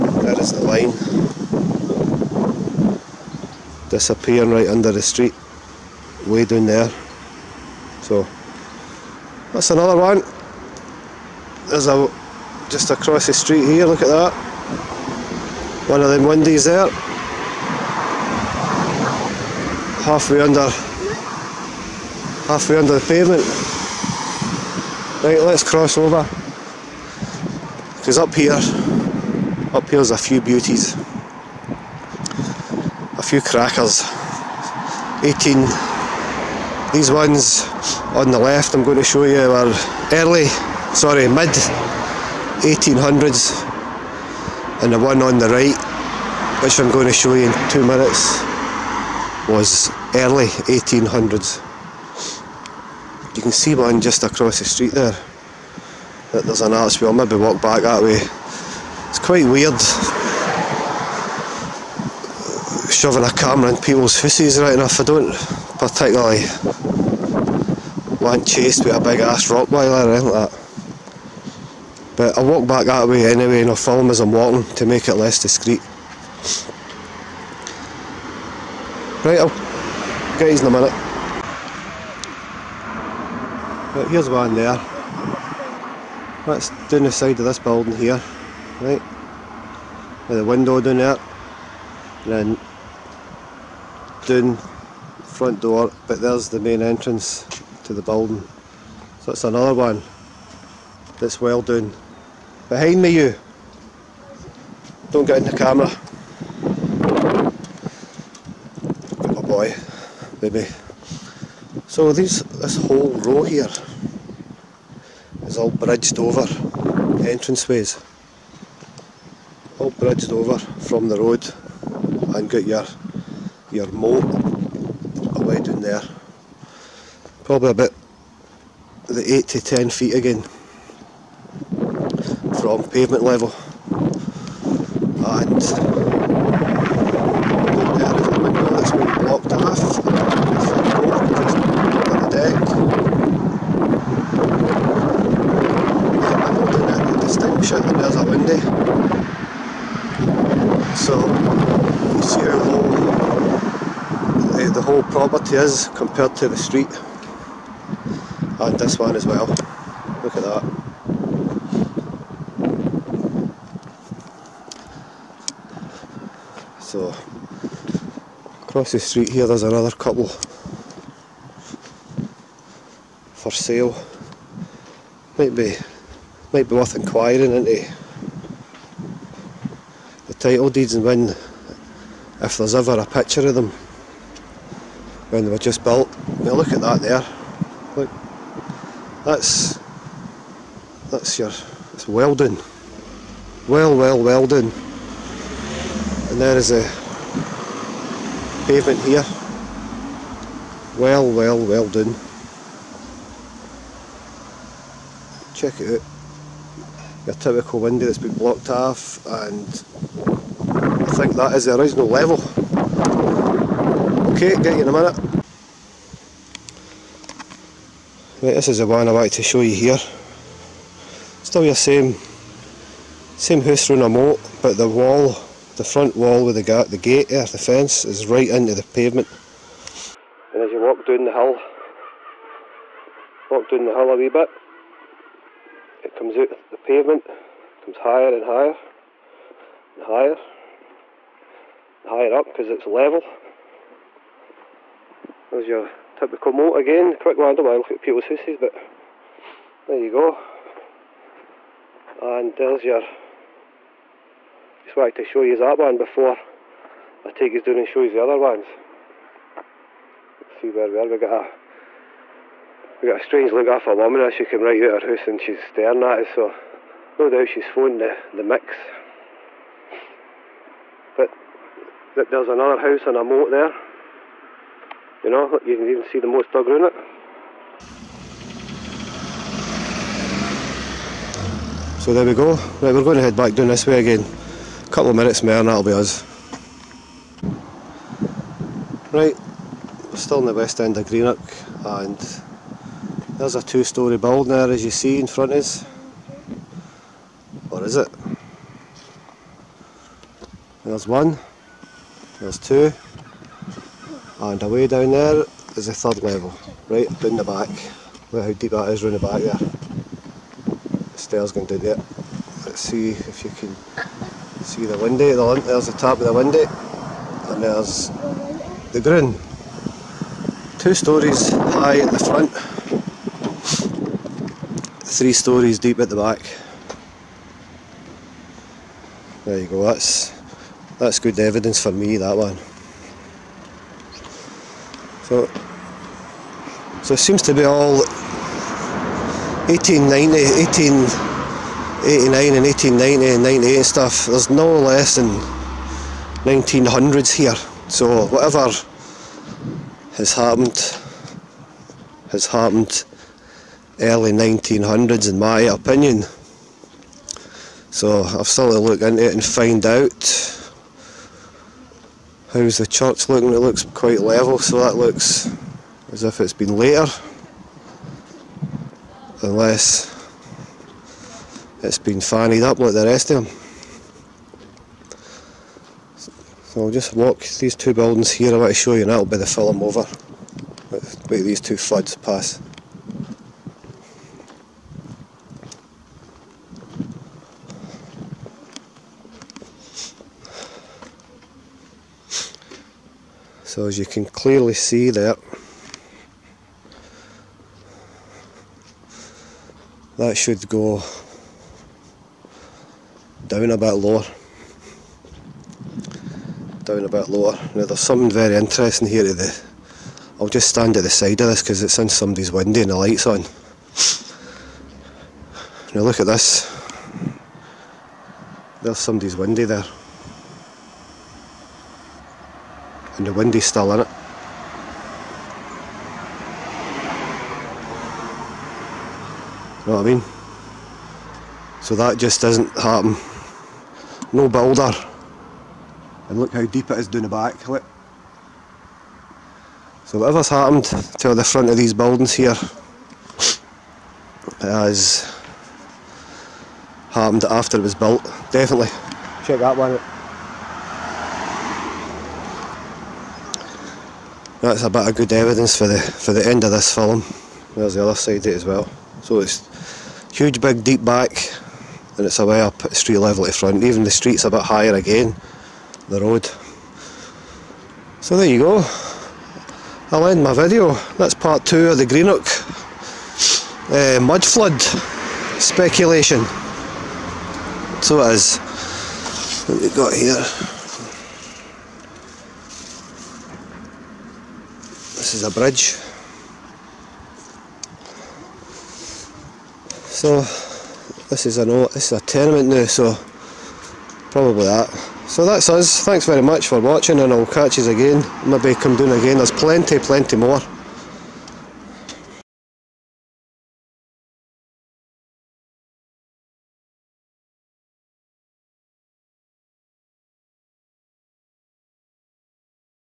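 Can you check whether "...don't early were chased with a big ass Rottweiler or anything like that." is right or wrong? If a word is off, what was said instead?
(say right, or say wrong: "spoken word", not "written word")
wrong: "particularly", not "early".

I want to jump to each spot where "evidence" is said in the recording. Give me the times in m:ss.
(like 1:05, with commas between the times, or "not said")
5:31, 7:35.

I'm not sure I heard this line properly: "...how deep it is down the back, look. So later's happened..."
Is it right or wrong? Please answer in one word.
wrong.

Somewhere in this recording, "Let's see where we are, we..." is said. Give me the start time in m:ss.
4:20.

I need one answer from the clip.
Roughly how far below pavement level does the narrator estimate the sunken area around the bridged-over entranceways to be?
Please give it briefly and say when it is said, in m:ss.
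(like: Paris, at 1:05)
8 to 10 feet, at 2:09.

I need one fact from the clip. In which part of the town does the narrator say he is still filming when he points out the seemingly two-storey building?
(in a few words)
west end.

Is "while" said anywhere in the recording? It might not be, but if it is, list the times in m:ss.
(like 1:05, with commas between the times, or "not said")
4:07.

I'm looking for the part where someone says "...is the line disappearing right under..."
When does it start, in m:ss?
0:00.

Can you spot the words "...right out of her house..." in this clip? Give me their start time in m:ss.
4:24.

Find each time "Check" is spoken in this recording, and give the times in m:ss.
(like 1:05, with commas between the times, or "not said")
3:25, 7:29.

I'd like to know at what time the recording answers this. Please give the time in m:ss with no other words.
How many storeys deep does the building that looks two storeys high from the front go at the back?
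5:25.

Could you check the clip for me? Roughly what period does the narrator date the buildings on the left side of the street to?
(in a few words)
mid 1800s.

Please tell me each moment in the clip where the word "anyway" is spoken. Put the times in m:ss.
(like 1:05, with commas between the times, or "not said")
1:13.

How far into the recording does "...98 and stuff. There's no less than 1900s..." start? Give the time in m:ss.
5:43.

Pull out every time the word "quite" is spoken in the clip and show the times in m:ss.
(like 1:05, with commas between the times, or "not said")
0:59, 6:03.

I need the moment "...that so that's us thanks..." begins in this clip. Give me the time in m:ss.
8:14.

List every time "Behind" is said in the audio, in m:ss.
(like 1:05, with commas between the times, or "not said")
1:42.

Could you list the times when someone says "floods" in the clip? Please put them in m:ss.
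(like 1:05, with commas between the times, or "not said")
6:21, 7:54.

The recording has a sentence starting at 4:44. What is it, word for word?
A couple of minutes more and that'll be us.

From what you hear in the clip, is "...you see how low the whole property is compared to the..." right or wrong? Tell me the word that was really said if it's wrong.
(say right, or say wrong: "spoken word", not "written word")
right.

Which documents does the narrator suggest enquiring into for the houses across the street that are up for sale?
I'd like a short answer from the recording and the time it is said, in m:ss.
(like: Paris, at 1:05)
title deeds, at 3:00.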